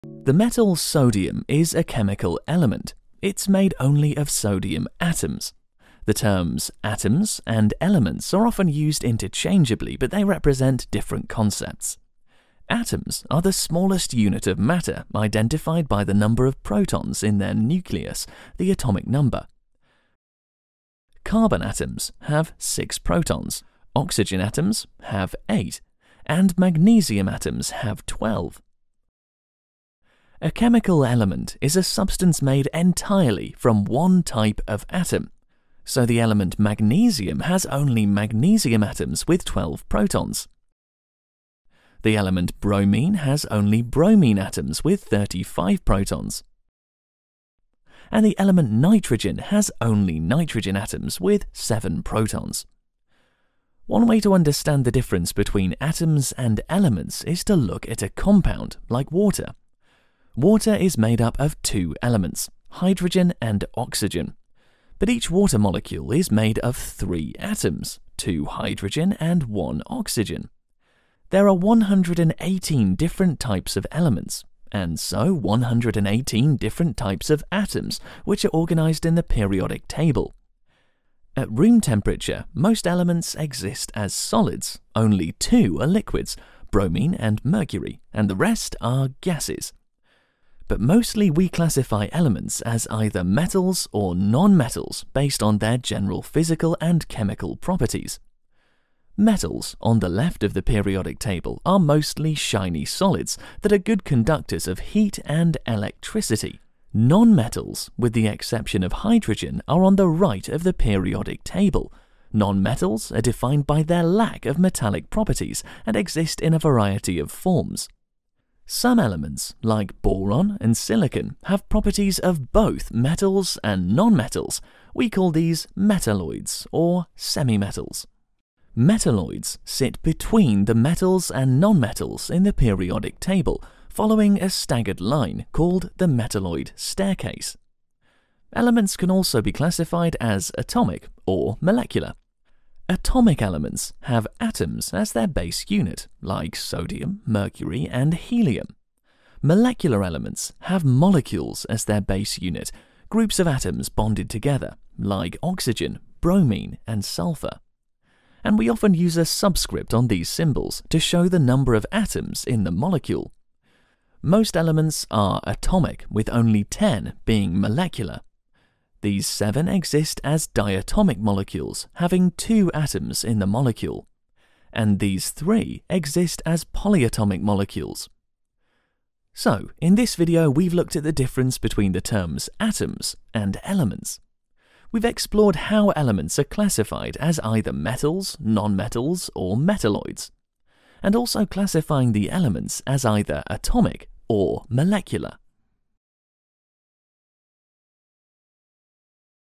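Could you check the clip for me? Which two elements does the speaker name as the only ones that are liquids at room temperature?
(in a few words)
bromine and mercury.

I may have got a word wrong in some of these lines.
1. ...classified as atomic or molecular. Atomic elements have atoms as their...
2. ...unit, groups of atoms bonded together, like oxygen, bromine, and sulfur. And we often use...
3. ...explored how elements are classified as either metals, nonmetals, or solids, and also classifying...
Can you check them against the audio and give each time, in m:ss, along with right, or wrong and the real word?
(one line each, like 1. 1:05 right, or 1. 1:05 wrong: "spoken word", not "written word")
1. 2:19 right
2. 2:32 right
3. 3:05 wrong: "metalloids", not "solids".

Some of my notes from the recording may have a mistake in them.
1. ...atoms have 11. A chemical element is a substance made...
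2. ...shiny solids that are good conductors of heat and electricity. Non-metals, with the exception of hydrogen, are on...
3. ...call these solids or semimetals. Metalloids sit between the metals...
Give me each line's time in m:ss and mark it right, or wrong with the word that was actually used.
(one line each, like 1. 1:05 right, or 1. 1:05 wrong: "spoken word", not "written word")
1. 0:27 wrong: "12", not "11"
2. 1:42 right
3. 2:05 wrong: "metalloids", not "solids".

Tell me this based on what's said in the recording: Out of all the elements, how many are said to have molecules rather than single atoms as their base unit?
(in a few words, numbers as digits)
10.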